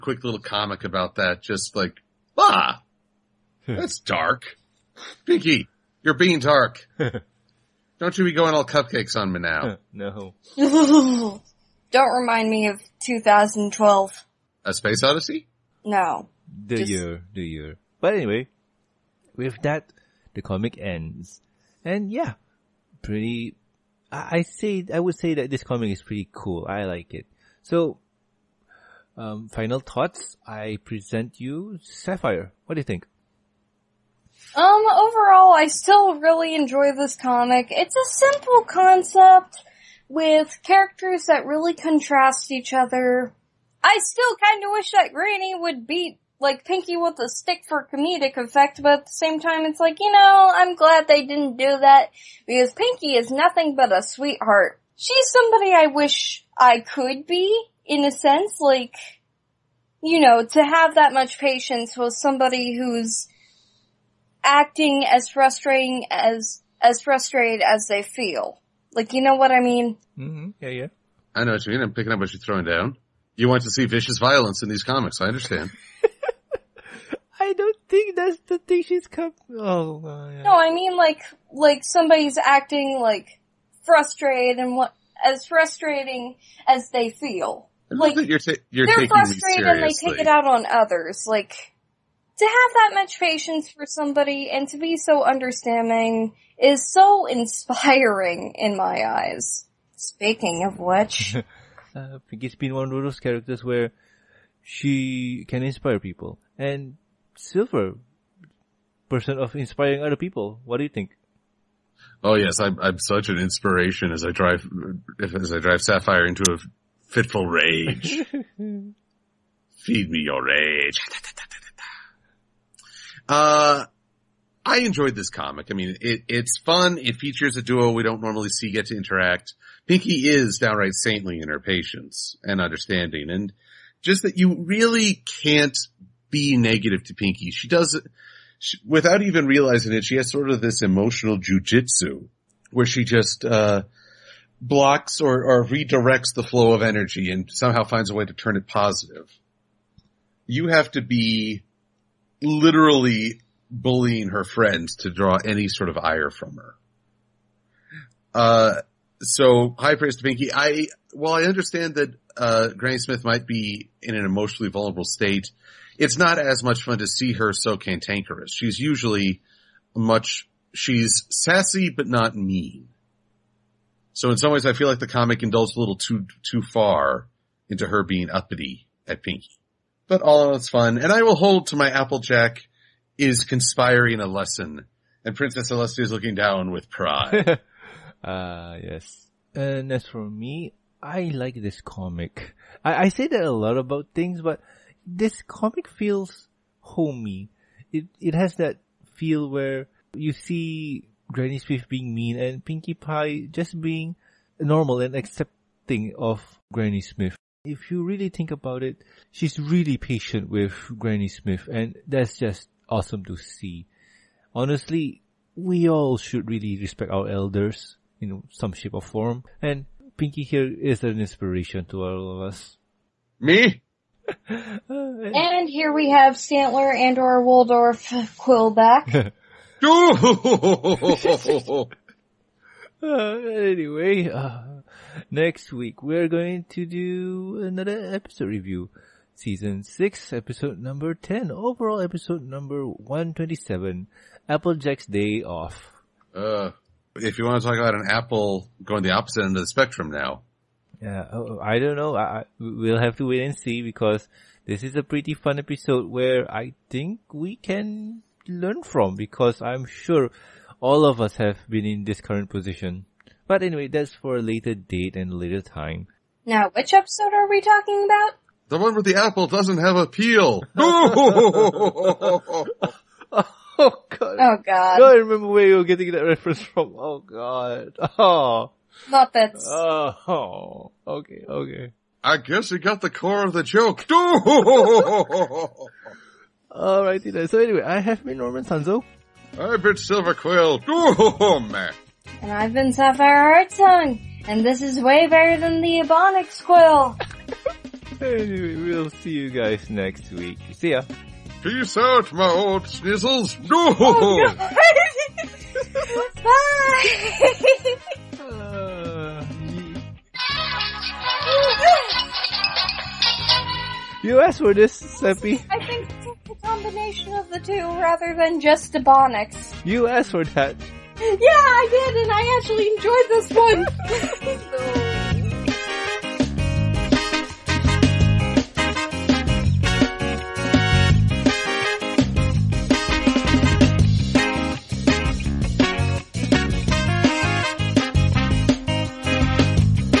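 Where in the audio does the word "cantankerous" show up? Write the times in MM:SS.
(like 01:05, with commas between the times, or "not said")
02:47.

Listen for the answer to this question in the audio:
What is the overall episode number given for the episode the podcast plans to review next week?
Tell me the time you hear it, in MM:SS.
04:02.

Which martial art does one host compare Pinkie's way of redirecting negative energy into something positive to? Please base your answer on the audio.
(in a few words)
jujitsu.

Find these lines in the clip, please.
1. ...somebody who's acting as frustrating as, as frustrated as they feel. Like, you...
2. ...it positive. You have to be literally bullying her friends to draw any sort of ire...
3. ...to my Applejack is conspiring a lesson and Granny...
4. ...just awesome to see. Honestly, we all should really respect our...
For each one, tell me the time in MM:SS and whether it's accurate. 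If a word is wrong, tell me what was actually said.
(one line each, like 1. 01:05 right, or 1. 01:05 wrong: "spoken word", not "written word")
1. 01:02 right
2. 02:28 right
3. 03:01 wrong: "Princess", not "Granny"
4. 03:32 right.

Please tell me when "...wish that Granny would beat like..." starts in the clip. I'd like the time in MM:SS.
00:44.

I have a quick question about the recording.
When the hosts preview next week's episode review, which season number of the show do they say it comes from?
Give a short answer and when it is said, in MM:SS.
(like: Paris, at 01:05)
6, at 03:59.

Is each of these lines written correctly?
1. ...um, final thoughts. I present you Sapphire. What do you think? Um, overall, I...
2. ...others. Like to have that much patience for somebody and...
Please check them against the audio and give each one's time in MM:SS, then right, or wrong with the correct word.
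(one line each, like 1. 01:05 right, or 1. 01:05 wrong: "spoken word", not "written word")
1. 00:29 right
2. 01:30 right.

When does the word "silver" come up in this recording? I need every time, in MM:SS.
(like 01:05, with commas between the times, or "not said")
01:47, 04:49.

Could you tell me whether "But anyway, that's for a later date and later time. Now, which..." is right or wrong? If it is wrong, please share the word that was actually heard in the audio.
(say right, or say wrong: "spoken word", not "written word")
right.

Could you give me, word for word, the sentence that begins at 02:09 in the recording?
Pinky is downright saintly in her patience and understanding and just that you really can't be negative to Pinky.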